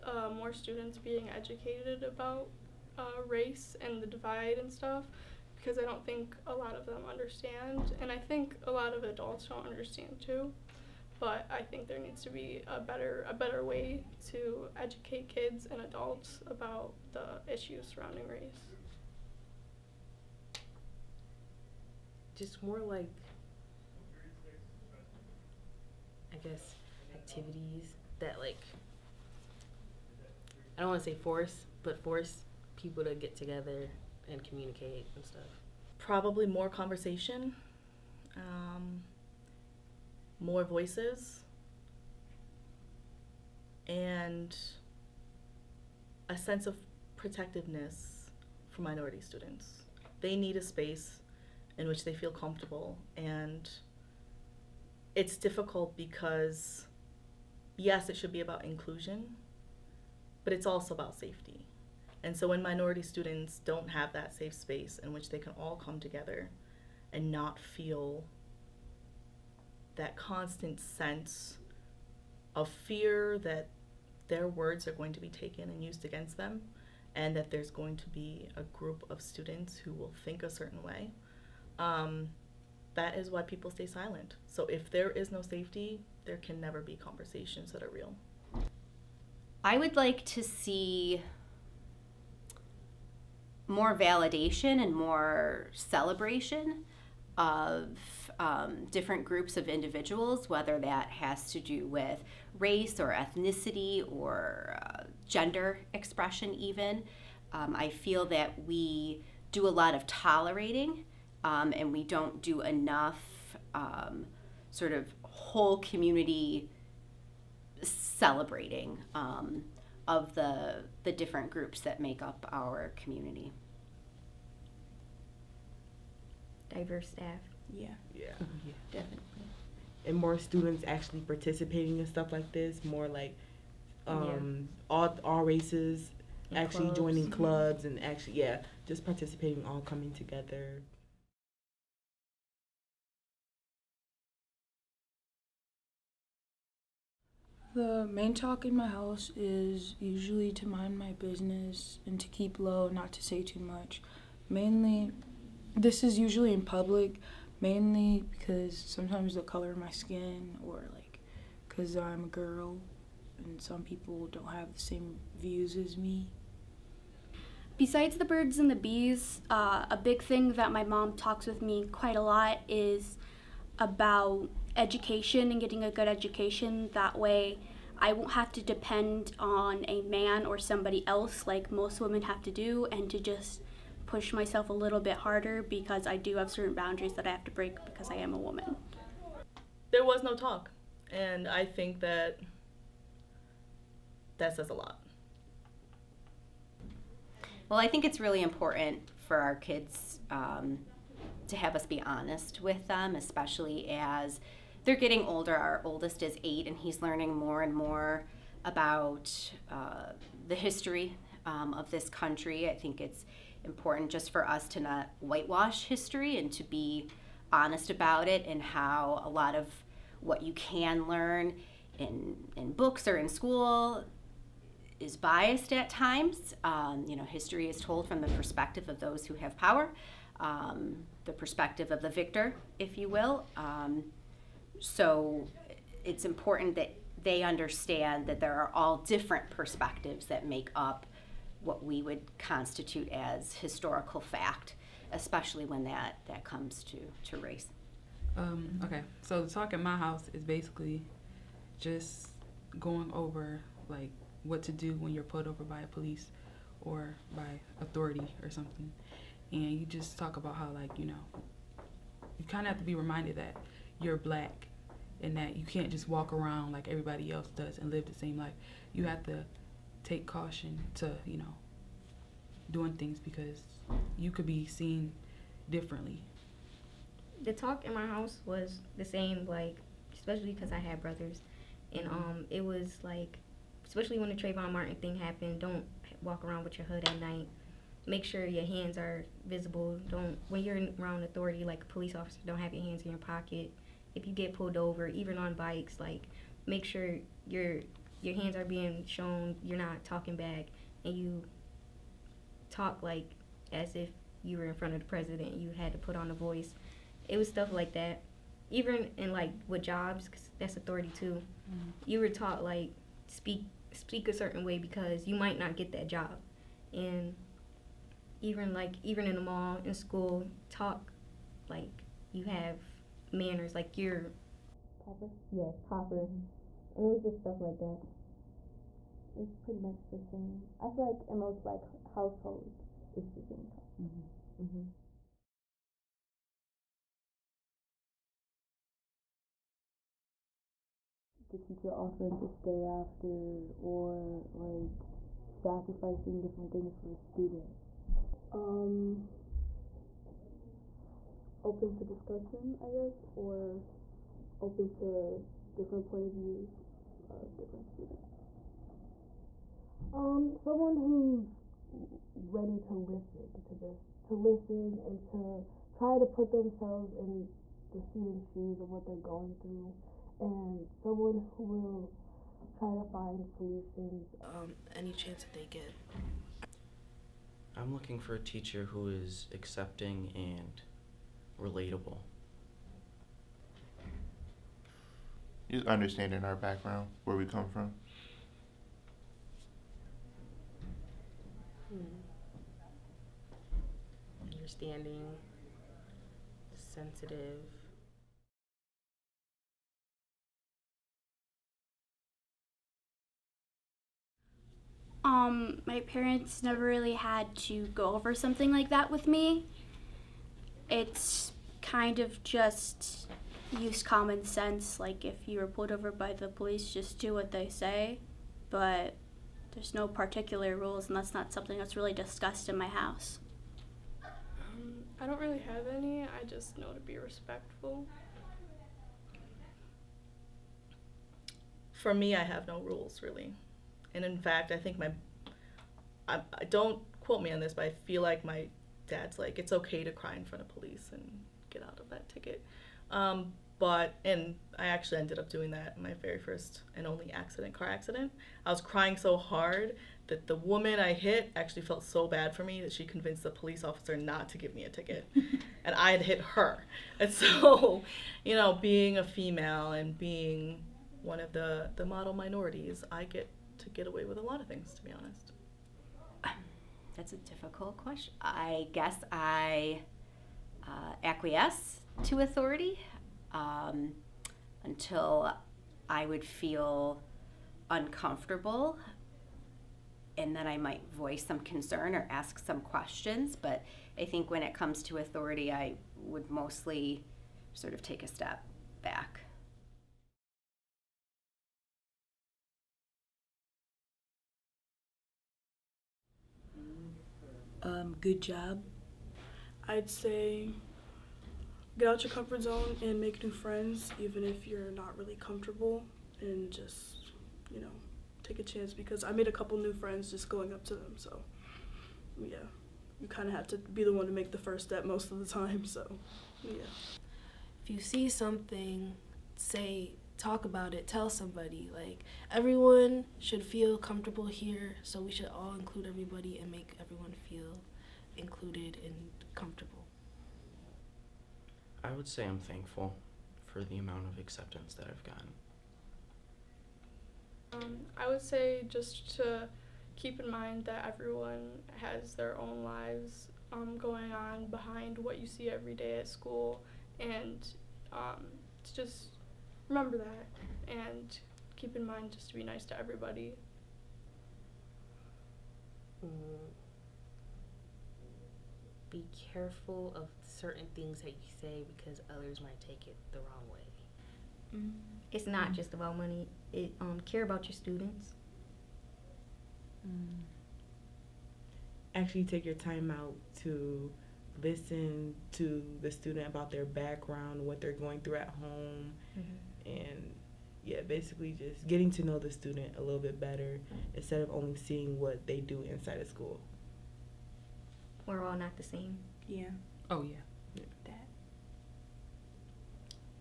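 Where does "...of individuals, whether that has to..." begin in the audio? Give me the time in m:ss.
1:39.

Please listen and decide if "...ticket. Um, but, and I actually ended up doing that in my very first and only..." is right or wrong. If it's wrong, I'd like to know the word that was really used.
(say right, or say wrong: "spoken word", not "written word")
right.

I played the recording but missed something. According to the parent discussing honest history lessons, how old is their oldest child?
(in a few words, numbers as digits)
8.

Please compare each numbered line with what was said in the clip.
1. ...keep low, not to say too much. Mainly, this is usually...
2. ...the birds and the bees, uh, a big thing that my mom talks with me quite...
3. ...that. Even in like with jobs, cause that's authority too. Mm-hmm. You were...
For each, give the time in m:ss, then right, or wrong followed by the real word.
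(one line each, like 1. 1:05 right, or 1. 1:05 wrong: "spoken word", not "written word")
1. 2:32 right
2. 2:48 right
3. 5:07 right.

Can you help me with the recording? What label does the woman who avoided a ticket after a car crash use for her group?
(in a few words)
model minorities.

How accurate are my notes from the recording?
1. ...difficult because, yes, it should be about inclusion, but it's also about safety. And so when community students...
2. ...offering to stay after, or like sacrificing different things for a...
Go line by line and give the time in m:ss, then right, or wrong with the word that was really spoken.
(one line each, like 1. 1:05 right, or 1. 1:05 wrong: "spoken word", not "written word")
1. 0:55 wrong: "minority", not "community"
2. 5:41 right.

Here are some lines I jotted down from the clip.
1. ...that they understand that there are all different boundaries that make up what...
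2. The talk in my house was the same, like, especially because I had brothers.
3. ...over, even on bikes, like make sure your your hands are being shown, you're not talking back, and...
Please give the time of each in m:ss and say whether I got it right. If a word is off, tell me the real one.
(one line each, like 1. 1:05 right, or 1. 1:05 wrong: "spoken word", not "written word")
1. 3:56 wrong: "perspectives", not "boundaries"
2. 4:37 right
3. 4:54 right.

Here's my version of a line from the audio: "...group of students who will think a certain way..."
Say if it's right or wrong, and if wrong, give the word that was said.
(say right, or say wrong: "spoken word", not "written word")
right.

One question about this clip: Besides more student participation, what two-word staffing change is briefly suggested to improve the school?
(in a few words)
Diverse staff.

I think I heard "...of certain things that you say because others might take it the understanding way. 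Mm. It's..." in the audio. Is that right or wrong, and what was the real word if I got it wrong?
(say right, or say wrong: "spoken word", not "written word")
wrong: "wrong", not "understanding".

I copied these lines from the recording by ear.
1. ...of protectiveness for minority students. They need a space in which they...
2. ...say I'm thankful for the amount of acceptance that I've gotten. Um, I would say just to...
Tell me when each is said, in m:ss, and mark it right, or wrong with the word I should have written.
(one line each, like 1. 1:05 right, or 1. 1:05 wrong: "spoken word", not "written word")
1. 0:46 right
2. 8:52 right.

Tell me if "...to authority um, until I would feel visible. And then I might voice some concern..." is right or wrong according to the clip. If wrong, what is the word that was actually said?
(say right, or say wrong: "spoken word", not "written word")
wrong: "uncomfortable", not "visible".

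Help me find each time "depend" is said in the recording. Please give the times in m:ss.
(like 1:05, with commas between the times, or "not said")
2:58.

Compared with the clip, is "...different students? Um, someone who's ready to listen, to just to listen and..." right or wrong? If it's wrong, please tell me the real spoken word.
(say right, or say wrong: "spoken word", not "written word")
right.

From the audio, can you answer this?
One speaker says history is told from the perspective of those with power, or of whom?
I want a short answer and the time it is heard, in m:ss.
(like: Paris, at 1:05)
the victor, at 3:52.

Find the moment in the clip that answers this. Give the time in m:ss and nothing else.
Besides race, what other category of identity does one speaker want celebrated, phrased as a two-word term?
1:45.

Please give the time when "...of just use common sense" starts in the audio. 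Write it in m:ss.
6:52.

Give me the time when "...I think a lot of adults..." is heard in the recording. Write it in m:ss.
0:08.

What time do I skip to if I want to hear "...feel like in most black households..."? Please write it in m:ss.
5:30.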